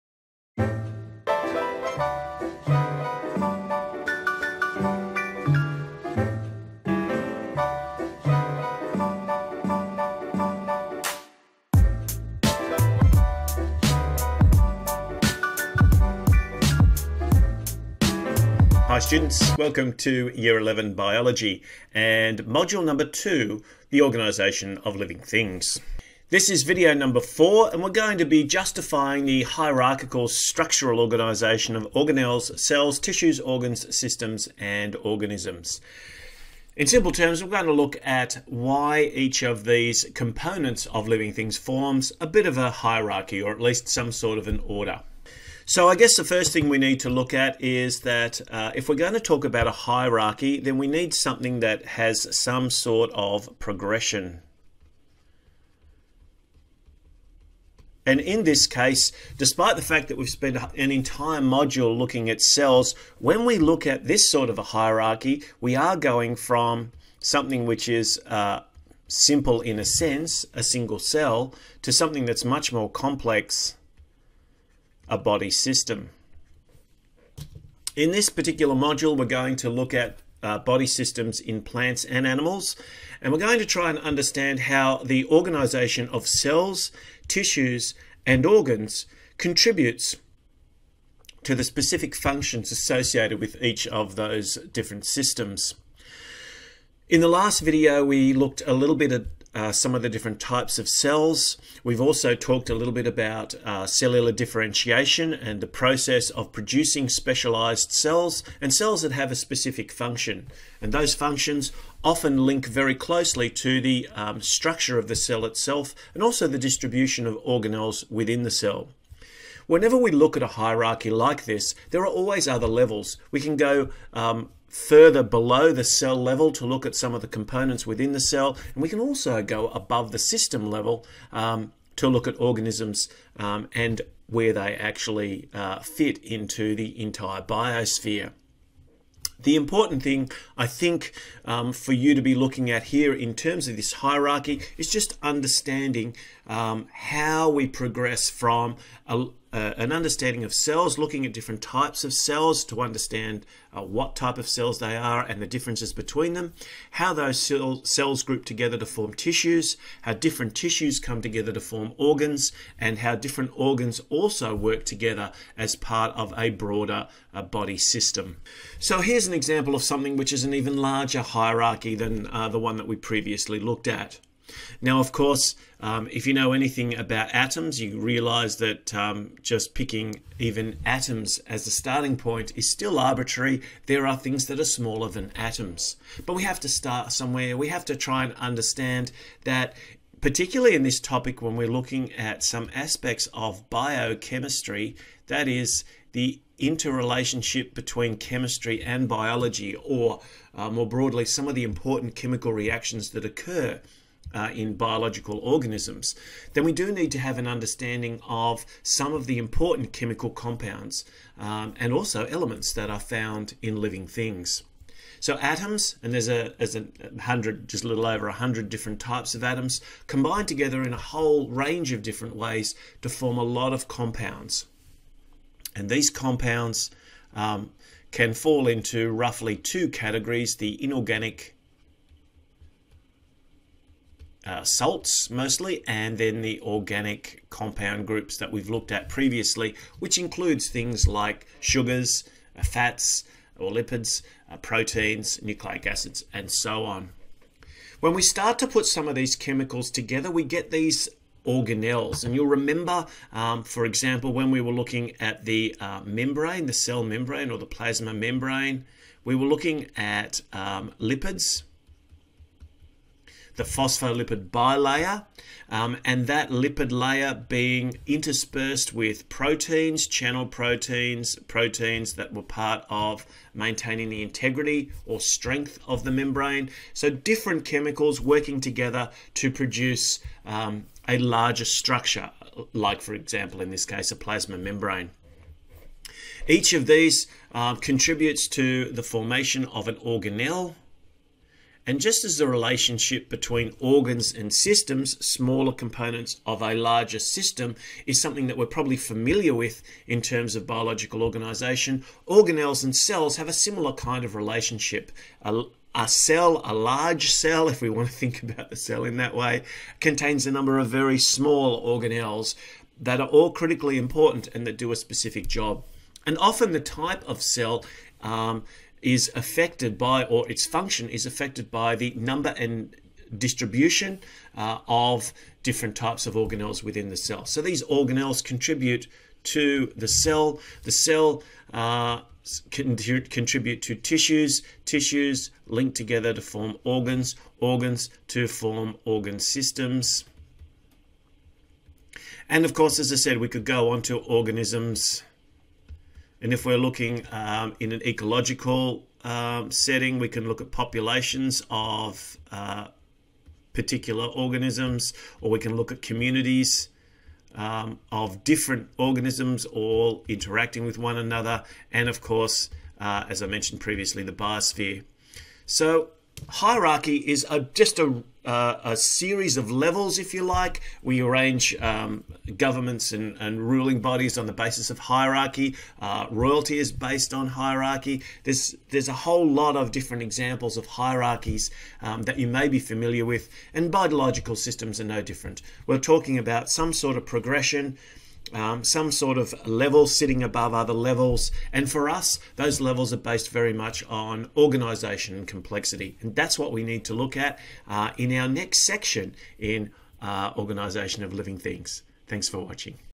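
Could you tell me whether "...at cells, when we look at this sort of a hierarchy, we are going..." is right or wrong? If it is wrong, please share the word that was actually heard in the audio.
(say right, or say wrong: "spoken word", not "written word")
right.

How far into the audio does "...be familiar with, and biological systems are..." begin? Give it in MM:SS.
06:22.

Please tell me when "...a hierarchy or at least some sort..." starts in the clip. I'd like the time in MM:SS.
00:42.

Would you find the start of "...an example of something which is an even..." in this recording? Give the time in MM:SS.
02:49.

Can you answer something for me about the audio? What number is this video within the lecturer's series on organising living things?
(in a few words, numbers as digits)
4.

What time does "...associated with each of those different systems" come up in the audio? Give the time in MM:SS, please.
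01:32.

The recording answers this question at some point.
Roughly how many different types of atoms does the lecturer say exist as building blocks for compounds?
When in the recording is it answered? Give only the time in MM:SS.
03:37.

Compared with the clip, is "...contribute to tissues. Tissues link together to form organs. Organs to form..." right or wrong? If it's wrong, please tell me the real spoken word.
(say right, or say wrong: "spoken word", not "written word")
right.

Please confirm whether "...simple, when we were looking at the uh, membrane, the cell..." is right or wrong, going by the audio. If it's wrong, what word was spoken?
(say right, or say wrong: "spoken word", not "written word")
wrong: "example", not "simple".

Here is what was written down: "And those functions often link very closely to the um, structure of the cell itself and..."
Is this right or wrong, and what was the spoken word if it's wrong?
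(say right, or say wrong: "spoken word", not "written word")
right.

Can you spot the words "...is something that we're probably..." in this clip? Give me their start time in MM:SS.
04:58.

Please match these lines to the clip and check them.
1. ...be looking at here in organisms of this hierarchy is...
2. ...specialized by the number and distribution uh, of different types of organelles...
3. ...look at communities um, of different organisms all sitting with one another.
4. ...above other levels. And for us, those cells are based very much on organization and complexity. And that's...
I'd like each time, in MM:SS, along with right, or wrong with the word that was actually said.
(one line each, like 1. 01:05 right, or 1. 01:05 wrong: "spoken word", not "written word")
1. 02:22 wrong: "terms", not "organisms"
2. 05:21 wrong: "affected", not "specialized"
3. 05:55 wrong: "interacting", not "sitting"
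4. 06:30 wrong: "levels", not "cells".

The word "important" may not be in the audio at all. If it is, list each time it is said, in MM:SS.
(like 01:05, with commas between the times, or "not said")
02:19, 03:21, 03:29, 05:13.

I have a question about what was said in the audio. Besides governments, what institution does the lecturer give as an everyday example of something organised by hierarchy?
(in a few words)
Royalty.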